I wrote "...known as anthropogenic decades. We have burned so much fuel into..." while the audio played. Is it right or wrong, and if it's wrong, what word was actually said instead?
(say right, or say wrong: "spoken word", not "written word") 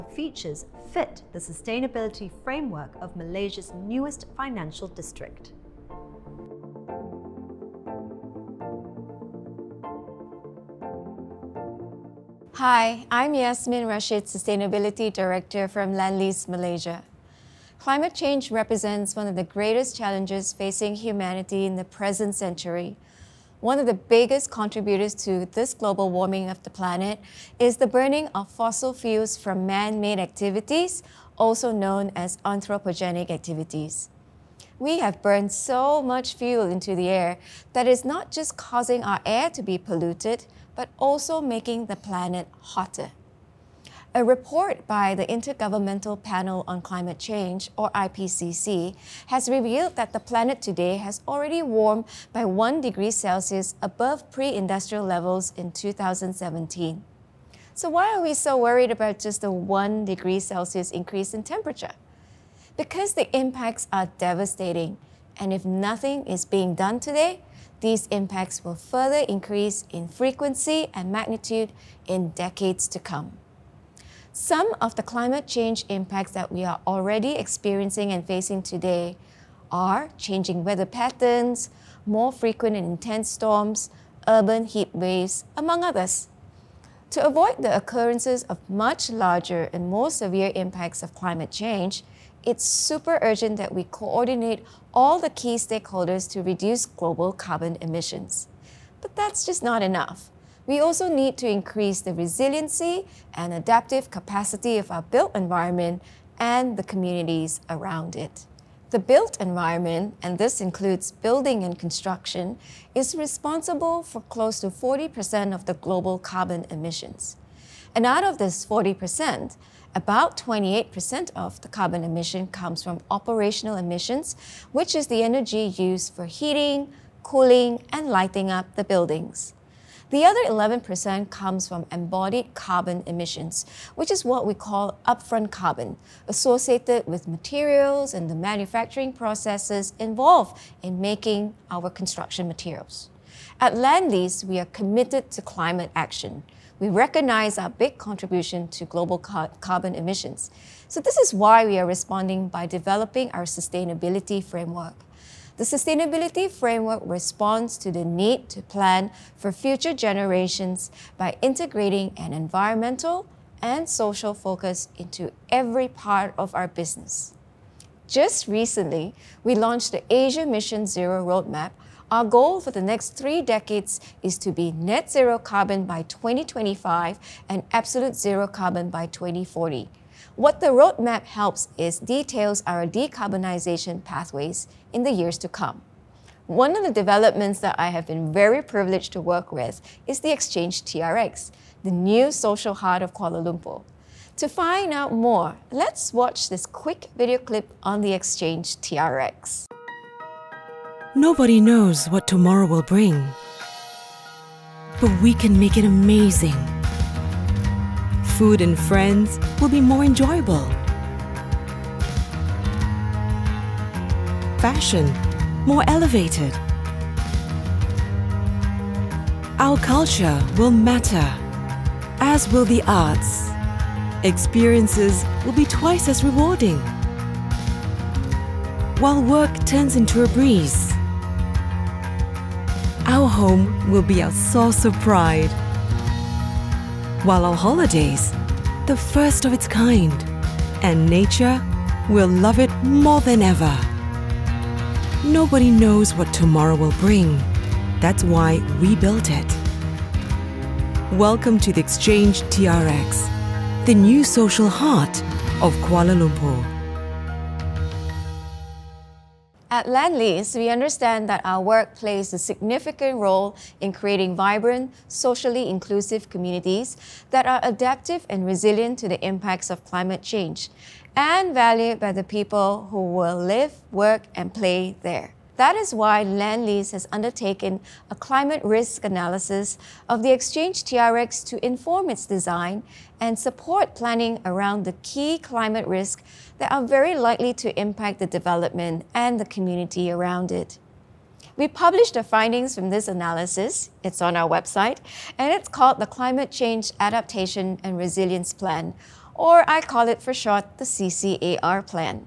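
wrong: "activities", not "decades".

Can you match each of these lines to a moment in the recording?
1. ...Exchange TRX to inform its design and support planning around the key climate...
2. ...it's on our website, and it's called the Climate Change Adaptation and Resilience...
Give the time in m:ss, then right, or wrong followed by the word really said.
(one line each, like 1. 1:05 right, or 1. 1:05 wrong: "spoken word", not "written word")
1. 4:40 right
2. 4:54 right.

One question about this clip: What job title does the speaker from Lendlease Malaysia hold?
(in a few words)
Sustainability Director.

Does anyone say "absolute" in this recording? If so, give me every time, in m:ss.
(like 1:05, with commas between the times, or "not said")
2:57.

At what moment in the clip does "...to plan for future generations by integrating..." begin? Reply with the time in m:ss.
2:38.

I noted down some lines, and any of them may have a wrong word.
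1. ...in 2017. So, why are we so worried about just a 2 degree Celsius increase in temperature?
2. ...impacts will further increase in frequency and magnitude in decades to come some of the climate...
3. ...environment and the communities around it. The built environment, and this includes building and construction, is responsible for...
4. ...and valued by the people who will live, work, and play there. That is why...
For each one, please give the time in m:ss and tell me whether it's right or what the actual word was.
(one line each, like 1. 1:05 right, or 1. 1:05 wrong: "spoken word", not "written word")
1. 0:55 wrong: "1", not "2"
2. 1:08 right
3. 1:45 right
4. 4:31 right.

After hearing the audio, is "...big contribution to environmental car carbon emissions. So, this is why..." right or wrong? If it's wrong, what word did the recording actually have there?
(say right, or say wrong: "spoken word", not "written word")
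wrong: "global", not "environmental".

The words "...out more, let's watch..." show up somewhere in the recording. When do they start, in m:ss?
3:14.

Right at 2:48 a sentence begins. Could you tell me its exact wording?
Just recently, we launched the Asia Mission Zero Roadmap.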